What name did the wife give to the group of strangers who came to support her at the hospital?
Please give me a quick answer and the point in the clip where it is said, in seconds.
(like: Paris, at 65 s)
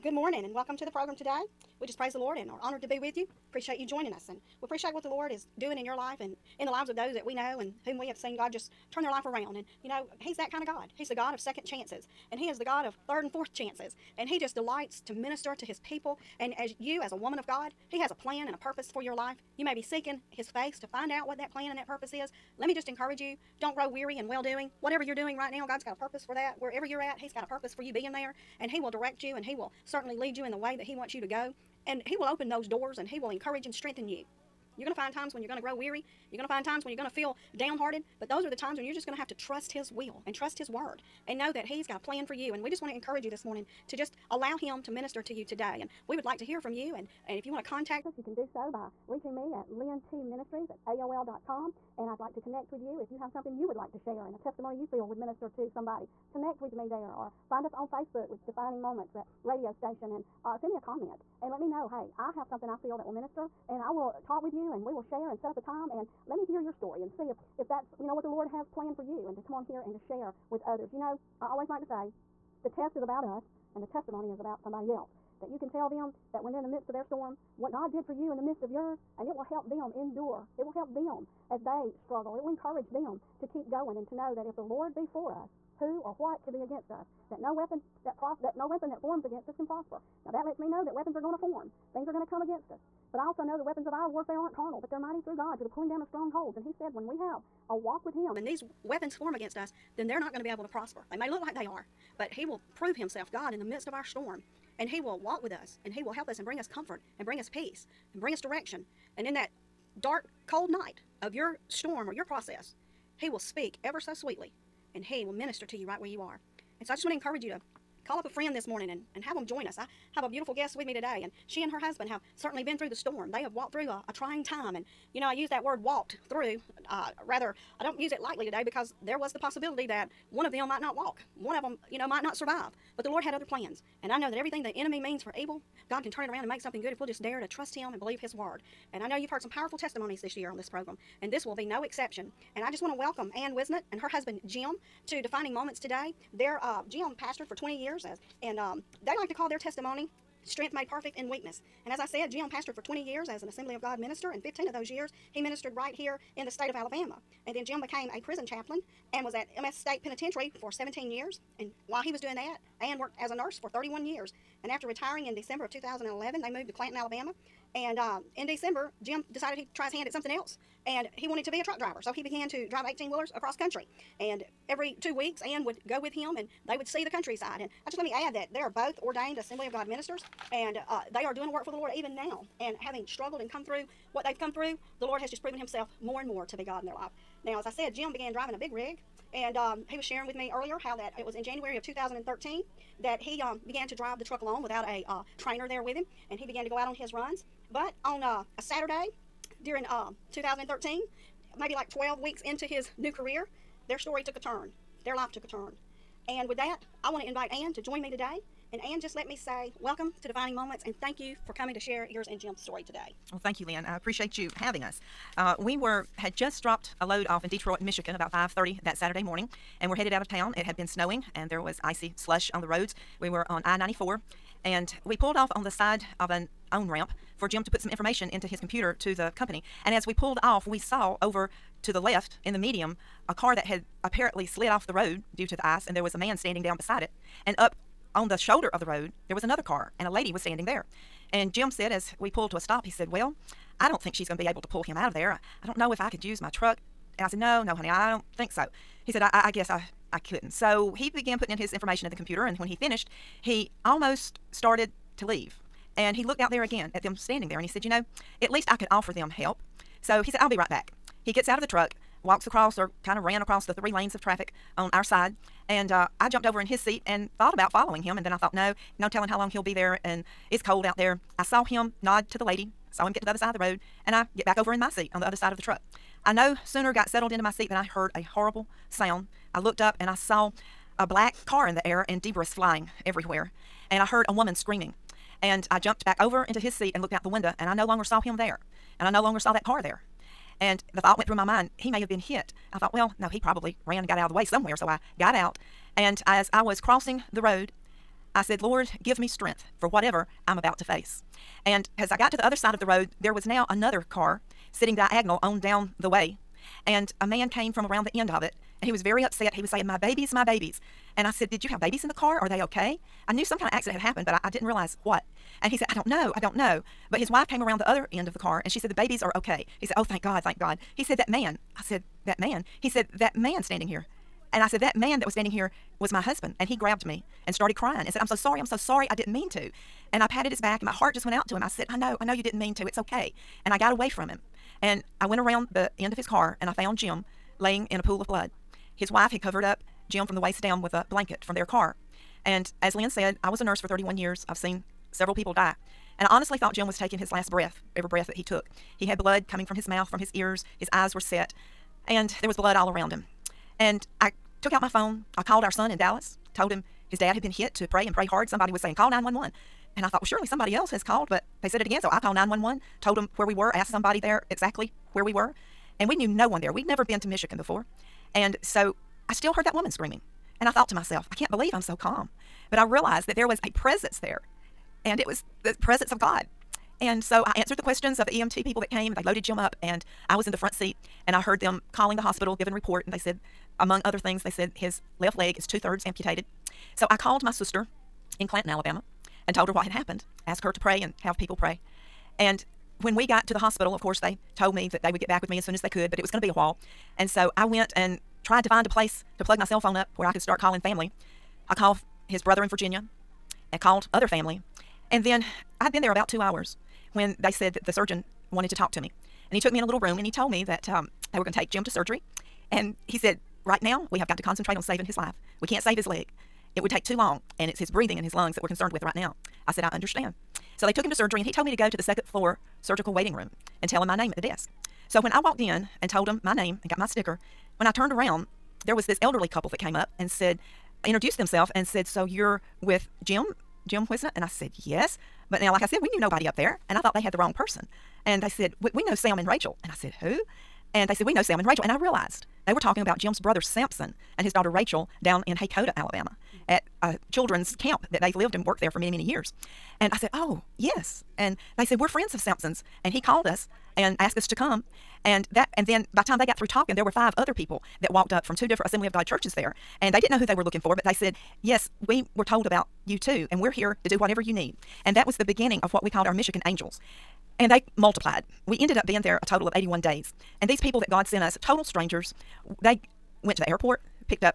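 Michigan angels, at 466 s.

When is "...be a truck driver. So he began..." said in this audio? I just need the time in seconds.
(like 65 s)
171 s.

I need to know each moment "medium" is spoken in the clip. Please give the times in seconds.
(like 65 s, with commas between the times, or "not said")
232 s.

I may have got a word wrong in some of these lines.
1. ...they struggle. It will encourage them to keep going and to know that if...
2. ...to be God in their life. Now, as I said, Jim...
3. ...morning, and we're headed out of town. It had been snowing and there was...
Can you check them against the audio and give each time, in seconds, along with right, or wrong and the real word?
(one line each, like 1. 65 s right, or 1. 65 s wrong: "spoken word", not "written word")
1. 81 s right
2. 186 s right
3. 219 s right.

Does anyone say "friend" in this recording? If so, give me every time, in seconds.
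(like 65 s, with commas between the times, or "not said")
118 s, 452 s.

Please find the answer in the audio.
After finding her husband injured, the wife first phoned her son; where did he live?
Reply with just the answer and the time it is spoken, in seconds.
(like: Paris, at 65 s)
Dallas, at 355 s.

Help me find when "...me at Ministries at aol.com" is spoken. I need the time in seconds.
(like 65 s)
49 s.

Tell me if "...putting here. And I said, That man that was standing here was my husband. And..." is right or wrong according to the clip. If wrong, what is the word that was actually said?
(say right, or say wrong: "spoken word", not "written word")
wrong: "standing", not "putting".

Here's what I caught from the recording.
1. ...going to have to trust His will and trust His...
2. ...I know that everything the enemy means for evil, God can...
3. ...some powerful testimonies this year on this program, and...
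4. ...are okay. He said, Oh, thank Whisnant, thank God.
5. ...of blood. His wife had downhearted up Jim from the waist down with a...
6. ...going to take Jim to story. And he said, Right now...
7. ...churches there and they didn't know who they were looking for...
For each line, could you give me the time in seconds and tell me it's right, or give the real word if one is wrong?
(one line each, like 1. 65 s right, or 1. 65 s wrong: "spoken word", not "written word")
1. 39 s right
2. 134 s right
3. 139 s right
4. 319 s wrong: "God", not "Whisnant"
5. 338 s wrong: "covered", not "downhearted"
6. 411 s wrong: "surgery", not "story"
7. 459 s right.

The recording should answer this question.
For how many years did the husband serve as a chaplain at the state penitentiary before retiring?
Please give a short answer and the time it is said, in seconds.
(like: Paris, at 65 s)
17, at 160 s.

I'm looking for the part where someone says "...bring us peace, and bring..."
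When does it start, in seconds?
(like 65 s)
107 s.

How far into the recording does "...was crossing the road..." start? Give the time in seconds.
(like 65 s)
296 s.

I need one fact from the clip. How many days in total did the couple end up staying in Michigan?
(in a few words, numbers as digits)
81.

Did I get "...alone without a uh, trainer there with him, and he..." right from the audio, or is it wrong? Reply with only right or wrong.
right.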